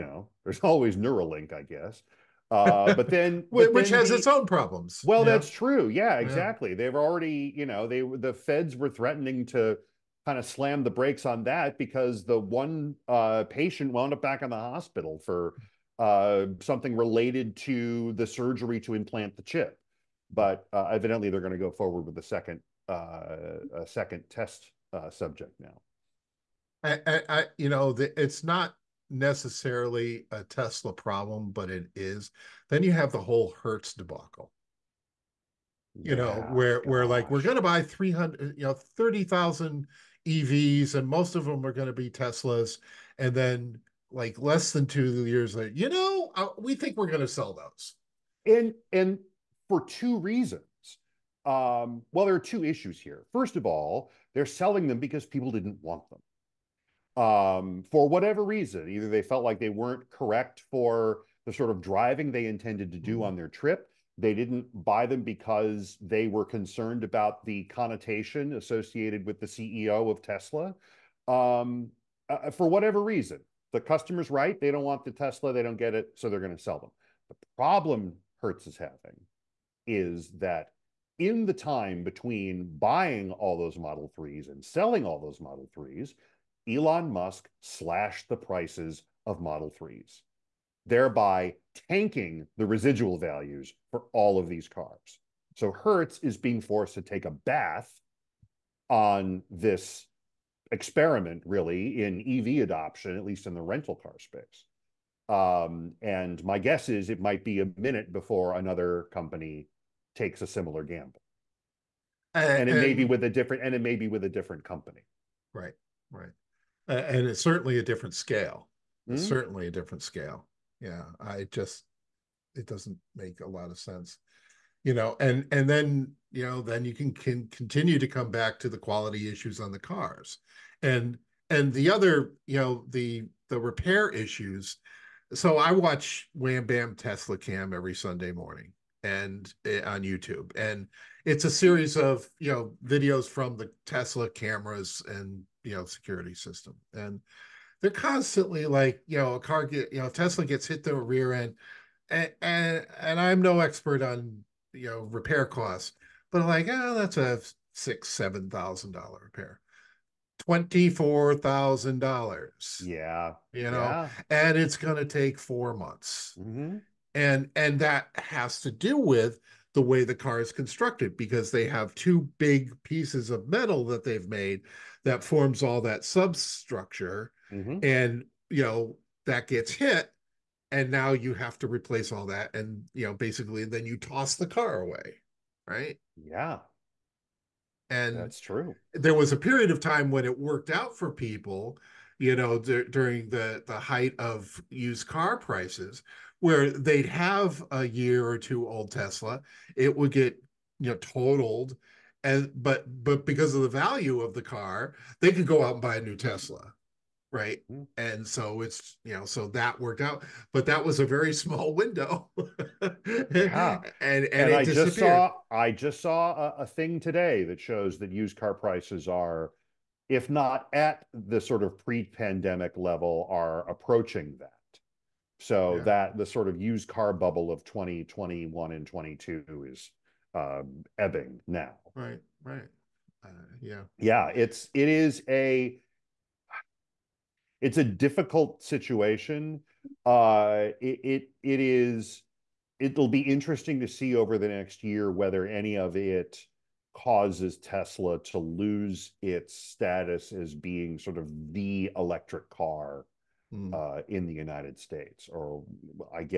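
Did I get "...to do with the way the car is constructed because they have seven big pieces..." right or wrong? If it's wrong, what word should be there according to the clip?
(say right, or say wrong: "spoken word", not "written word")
wrong: "two", not "seven".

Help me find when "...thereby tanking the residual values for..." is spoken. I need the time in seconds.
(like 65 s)
90 s.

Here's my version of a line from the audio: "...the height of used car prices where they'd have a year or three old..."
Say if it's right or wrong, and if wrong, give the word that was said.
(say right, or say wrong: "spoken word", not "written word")
wrong: "two", not "three".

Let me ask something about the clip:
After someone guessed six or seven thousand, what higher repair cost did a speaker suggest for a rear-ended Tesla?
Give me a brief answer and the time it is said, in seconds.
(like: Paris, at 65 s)
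$24,000, at 160 s.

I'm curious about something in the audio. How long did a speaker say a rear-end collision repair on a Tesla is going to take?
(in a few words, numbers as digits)
4 months.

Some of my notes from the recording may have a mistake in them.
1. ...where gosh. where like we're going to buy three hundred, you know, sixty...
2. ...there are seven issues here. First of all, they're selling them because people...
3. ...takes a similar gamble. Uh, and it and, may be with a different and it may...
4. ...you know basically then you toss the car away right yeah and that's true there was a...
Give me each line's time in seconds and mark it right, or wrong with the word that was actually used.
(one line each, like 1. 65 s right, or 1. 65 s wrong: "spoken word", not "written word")
1. 36 s wrong: "thirty", not "sixty"
2. 52 s wrong: "two", not "seven"
3. 110 s right
4. 182 s right.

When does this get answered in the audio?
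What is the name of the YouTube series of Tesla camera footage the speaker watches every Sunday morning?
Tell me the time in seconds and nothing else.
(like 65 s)
136 s.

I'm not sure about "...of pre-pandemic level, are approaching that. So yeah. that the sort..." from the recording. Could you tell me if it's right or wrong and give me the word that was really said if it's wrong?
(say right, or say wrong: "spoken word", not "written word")
right.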